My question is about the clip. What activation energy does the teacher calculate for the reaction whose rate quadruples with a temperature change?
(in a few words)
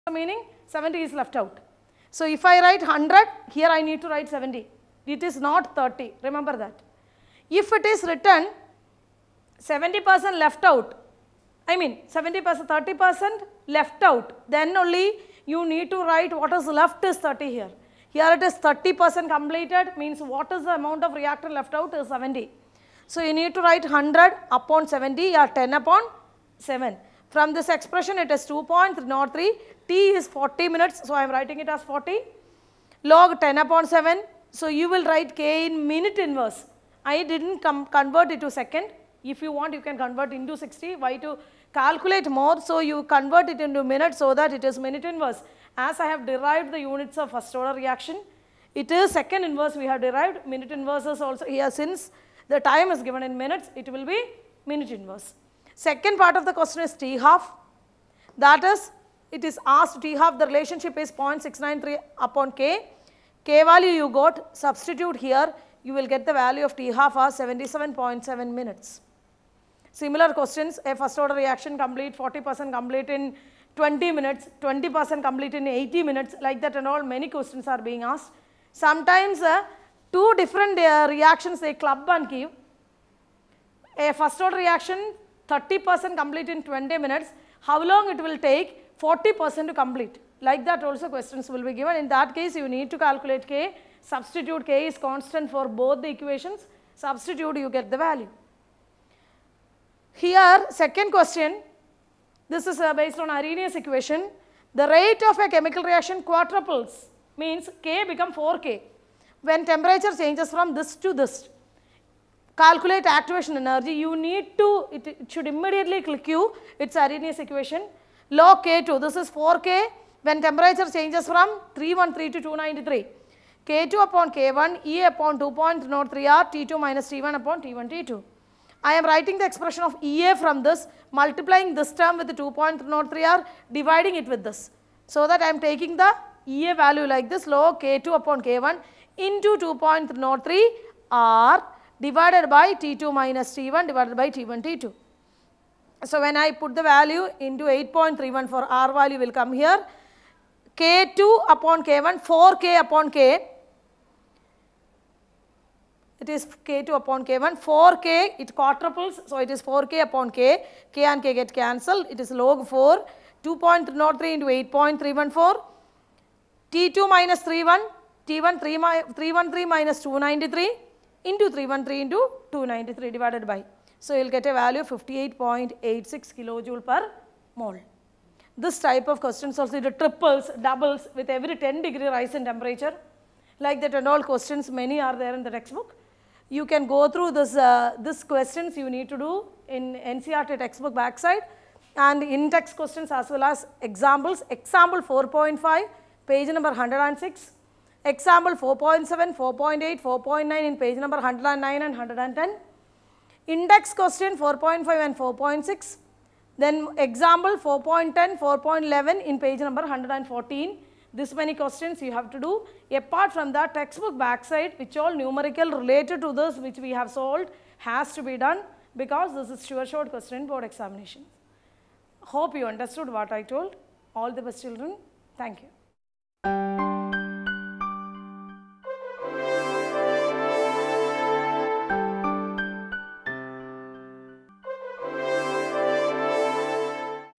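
58.86 kJ/mol.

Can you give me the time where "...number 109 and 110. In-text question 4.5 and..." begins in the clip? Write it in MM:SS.
03:20.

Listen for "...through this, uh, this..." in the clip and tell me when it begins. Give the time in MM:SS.
03:07.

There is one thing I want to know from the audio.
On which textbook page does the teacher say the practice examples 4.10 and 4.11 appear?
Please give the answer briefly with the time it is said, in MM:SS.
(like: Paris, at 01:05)
114, at 03:29.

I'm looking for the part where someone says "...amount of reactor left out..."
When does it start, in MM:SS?
00:20.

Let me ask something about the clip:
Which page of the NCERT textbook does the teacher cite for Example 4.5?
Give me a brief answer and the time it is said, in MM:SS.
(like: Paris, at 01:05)
106, at 03:16.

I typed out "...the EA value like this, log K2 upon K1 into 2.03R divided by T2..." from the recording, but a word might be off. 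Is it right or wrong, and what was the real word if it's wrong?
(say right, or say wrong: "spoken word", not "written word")
right.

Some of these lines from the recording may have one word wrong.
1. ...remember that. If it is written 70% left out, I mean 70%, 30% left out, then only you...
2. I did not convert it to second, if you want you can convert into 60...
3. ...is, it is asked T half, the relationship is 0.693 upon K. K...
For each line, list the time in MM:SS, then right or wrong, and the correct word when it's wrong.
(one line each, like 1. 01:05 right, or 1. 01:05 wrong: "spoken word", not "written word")
1. 00:06 right
2. 00:37 right
3. 00:58 right.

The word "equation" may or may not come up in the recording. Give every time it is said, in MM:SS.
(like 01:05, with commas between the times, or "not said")
01:36, 01:43, 01:57.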